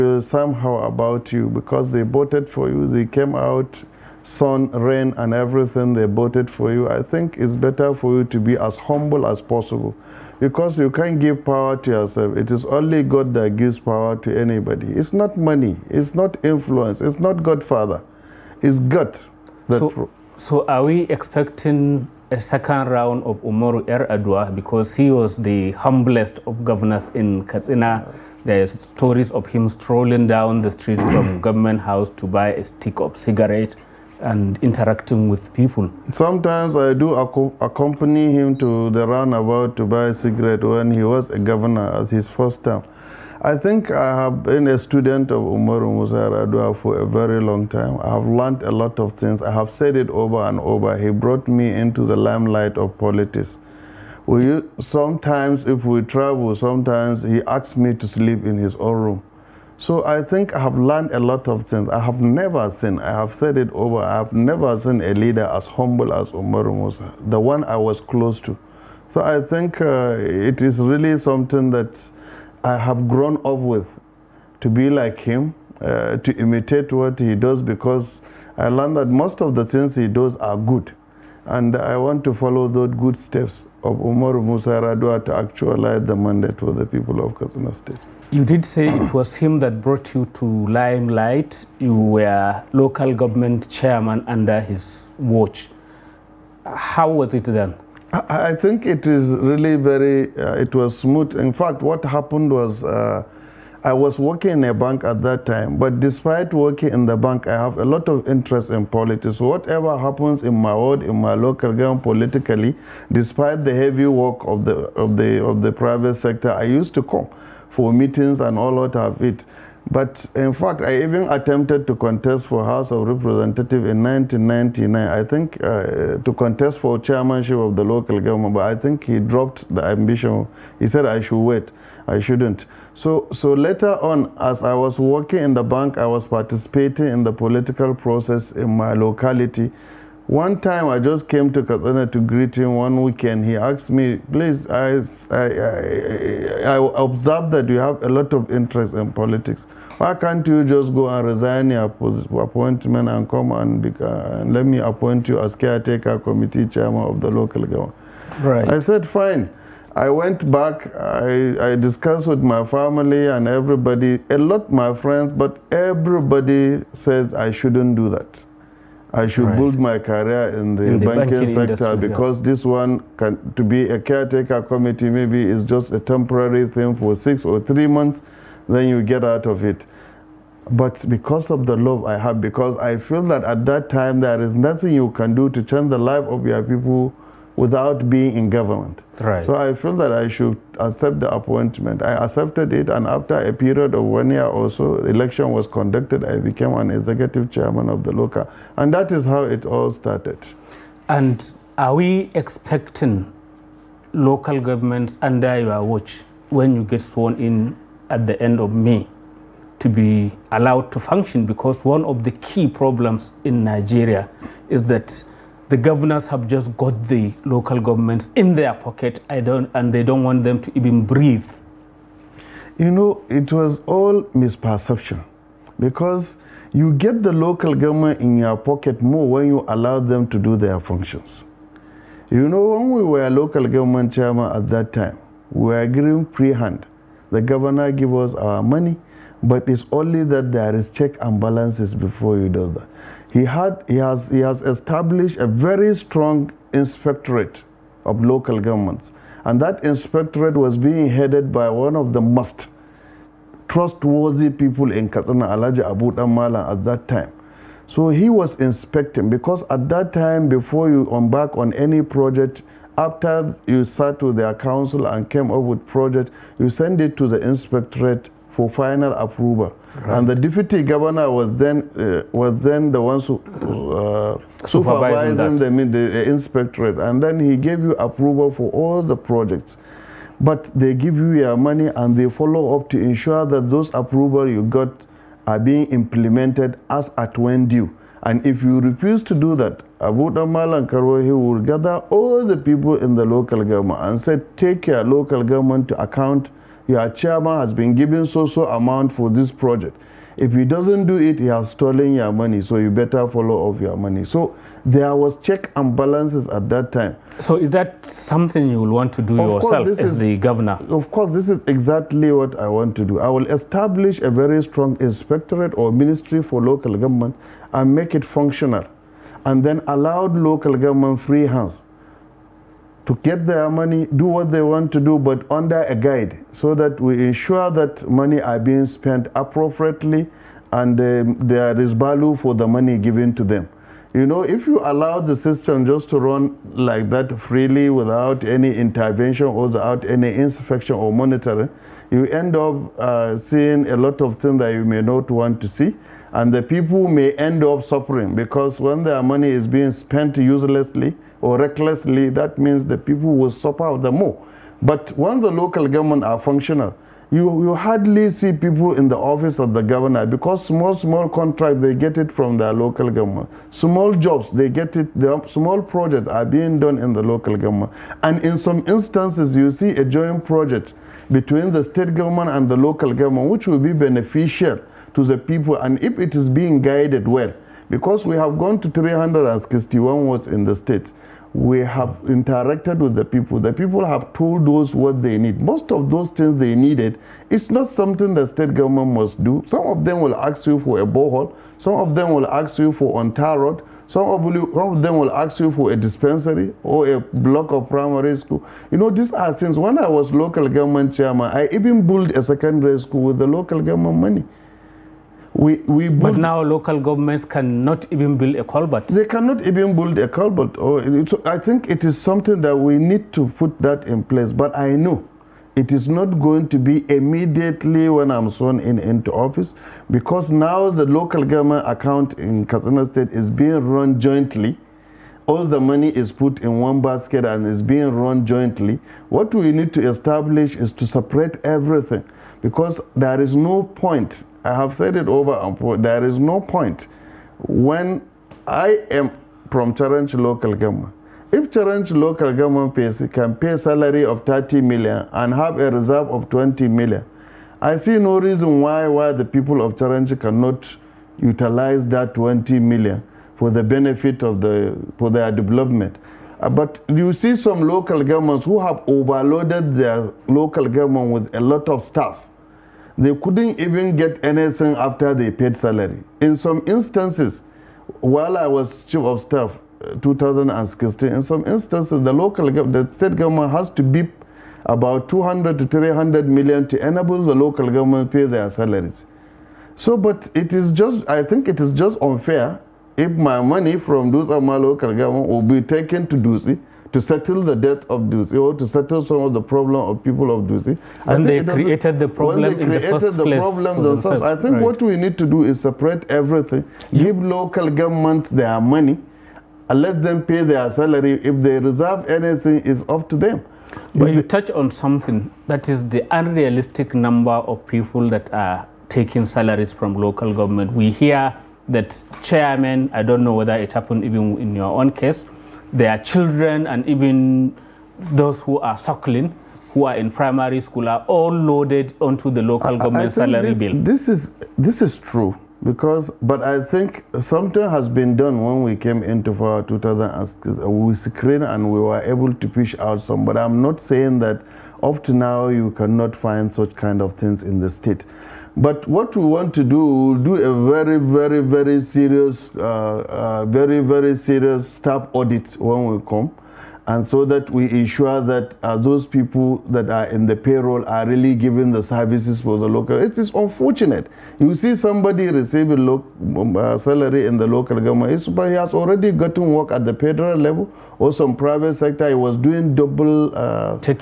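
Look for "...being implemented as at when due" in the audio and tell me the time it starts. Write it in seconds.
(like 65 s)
285 s.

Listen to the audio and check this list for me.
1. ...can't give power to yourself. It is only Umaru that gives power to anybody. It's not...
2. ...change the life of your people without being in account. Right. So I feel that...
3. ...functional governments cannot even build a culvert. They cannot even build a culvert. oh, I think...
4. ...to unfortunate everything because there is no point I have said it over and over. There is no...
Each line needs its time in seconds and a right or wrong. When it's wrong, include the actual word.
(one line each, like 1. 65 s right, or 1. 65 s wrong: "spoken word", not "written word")
1. 10 s wrong: "God", not "Umaru"
2. 185 s wrong: "government", not "account"
3. 406 s wrong: "local", not "functional"
4. 430 s wrong: "separate", not "unfortunate".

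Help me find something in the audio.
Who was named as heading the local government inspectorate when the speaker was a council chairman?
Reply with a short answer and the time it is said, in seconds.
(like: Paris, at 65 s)
Alaja Abu Damala, at 255 s.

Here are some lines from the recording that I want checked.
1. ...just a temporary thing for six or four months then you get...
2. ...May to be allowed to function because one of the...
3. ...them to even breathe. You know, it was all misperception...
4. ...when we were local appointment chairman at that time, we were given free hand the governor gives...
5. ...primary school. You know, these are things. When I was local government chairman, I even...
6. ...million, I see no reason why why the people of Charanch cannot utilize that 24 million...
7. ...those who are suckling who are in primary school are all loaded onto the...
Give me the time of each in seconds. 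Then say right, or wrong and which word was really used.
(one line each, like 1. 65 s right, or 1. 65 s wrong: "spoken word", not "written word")
1. 175 s wrong: "three", not "four"
2. 208 s right
3. 220 s right
4. 232 s wrong: "government", not "appointment"
5. 397 s right
6. 446 s wrong: "20", not "24"
7. 518 s right.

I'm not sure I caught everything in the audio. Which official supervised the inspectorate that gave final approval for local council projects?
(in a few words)
the deputy governor.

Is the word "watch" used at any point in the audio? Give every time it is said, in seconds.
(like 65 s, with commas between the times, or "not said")
95 s, 205 s.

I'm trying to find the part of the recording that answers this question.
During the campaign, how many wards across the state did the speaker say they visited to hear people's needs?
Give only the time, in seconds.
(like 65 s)
378 s.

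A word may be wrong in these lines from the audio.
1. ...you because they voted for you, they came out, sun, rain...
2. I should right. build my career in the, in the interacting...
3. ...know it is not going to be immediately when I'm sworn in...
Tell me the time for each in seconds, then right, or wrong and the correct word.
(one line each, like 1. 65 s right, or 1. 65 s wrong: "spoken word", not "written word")
1. 1 s right
2. 169 s wrong: "banking", not "interacting"
3. 414 s right.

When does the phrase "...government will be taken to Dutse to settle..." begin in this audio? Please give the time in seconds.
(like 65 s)
485 s.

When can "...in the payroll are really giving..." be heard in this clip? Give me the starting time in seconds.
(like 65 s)
550 s.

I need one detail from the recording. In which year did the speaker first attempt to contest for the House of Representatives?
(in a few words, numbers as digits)
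1999.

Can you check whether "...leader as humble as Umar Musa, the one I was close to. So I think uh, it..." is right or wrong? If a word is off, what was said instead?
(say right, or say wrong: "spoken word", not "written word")
right.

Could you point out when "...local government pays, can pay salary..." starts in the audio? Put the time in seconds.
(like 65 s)
442 s.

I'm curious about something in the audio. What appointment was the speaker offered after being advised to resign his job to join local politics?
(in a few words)
caretaker committee chairman.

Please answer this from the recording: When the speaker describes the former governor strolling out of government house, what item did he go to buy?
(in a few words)
a stick of cigarette.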